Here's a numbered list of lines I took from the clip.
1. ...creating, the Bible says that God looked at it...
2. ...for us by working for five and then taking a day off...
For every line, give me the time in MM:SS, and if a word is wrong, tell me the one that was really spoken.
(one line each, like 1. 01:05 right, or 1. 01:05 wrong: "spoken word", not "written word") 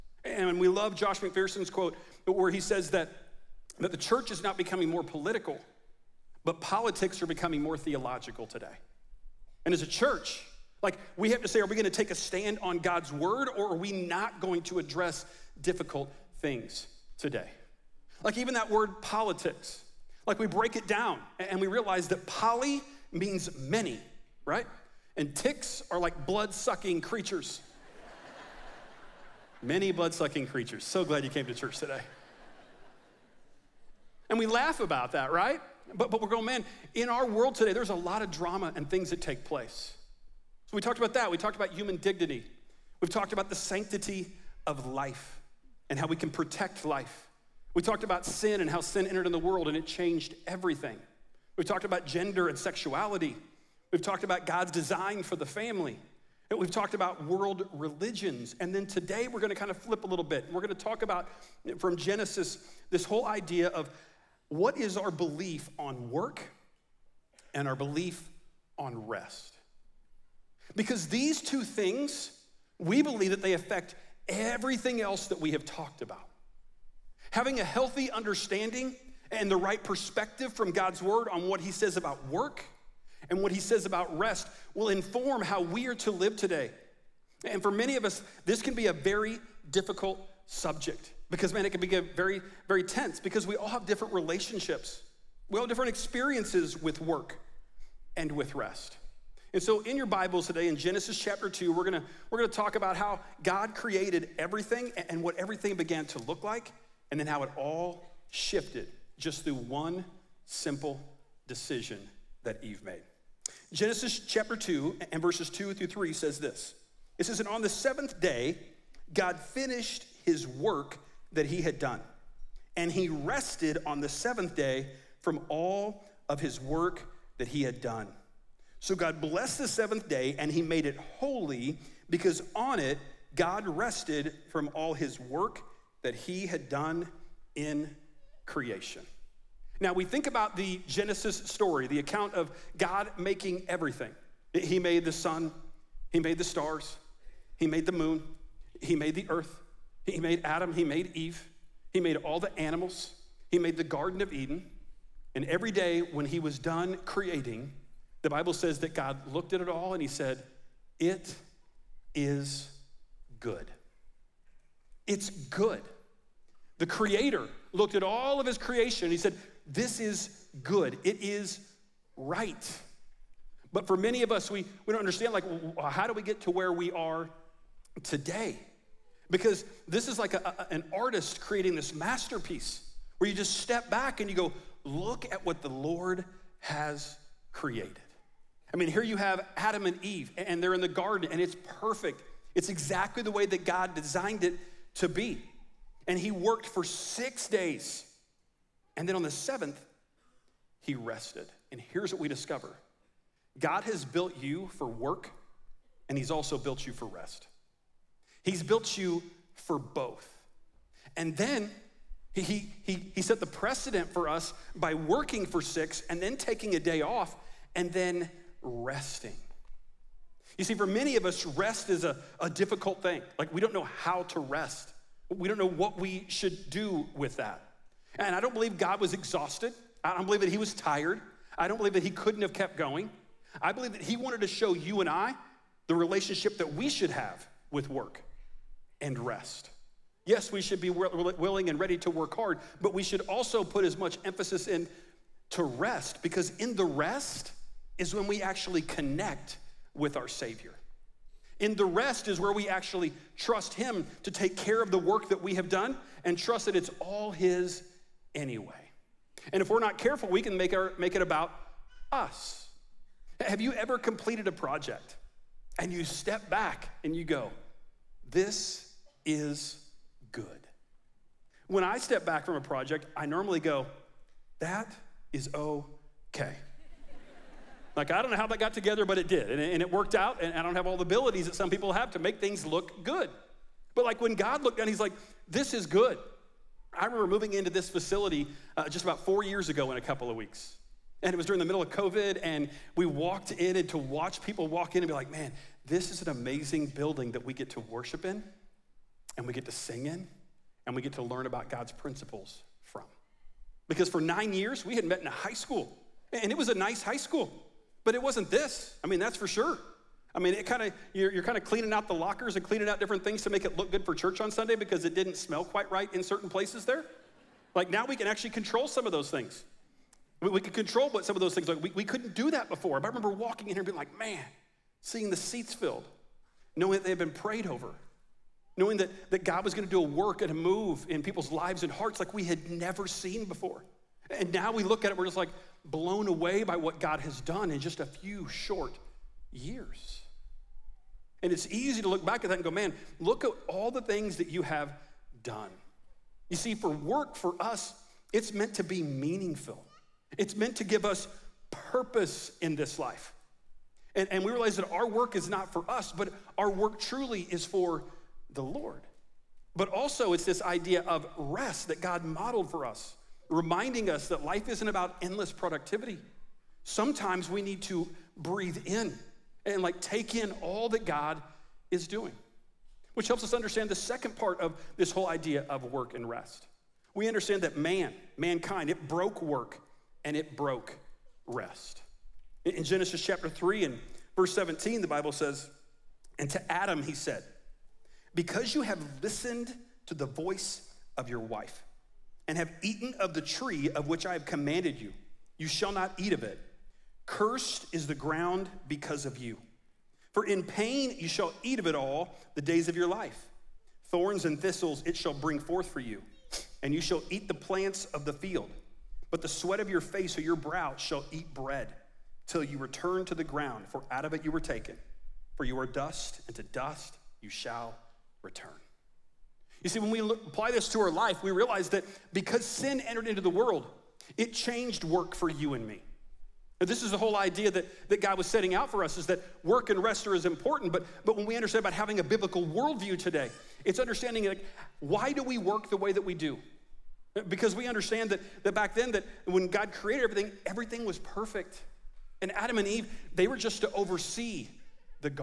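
1. 02:37 right
2. 03:34 wrong: "six", not "five".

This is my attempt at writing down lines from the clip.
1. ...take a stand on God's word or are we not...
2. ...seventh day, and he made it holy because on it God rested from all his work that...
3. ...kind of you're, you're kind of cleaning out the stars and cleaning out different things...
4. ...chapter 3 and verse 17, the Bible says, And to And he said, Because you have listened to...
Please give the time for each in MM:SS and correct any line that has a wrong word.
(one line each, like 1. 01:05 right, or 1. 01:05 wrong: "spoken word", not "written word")
1. 00:11 right
2. 02:09 right
3. 05:10 wrong: "lockers", not "stars"
4. 06:23 wrong: "Adam", not "And".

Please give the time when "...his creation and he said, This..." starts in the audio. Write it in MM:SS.
02:48.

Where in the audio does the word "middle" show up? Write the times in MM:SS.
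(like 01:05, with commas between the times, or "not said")
04:51.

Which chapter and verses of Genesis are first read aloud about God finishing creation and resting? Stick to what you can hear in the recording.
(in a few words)
Genesis 2:2-3.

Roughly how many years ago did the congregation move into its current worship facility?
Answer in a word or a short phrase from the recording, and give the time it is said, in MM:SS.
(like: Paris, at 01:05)
4 years, at 04:49.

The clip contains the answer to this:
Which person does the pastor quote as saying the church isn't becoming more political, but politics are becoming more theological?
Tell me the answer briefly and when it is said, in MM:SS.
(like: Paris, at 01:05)
Josh McPherson, at 00:00.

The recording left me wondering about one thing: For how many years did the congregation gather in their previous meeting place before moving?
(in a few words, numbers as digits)
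9 years.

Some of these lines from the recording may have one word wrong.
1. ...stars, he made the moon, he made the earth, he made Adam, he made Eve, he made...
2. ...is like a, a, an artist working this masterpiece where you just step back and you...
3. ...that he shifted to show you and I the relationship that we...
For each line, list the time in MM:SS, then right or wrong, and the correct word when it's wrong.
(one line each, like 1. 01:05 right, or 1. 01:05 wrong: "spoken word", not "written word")
1. 02:26 right
2. 03:00 wrong: "creating", not "working"
3. 03:53 wrong: "wanted", not "shifted".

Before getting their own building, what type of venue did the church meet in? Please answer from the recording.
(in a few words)
a high school.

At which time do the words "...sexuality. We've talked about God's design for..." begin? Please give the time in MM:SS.
00:52.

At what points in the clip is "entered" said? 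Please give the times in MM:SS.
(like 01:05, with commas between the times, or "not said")
00:49, 07:03.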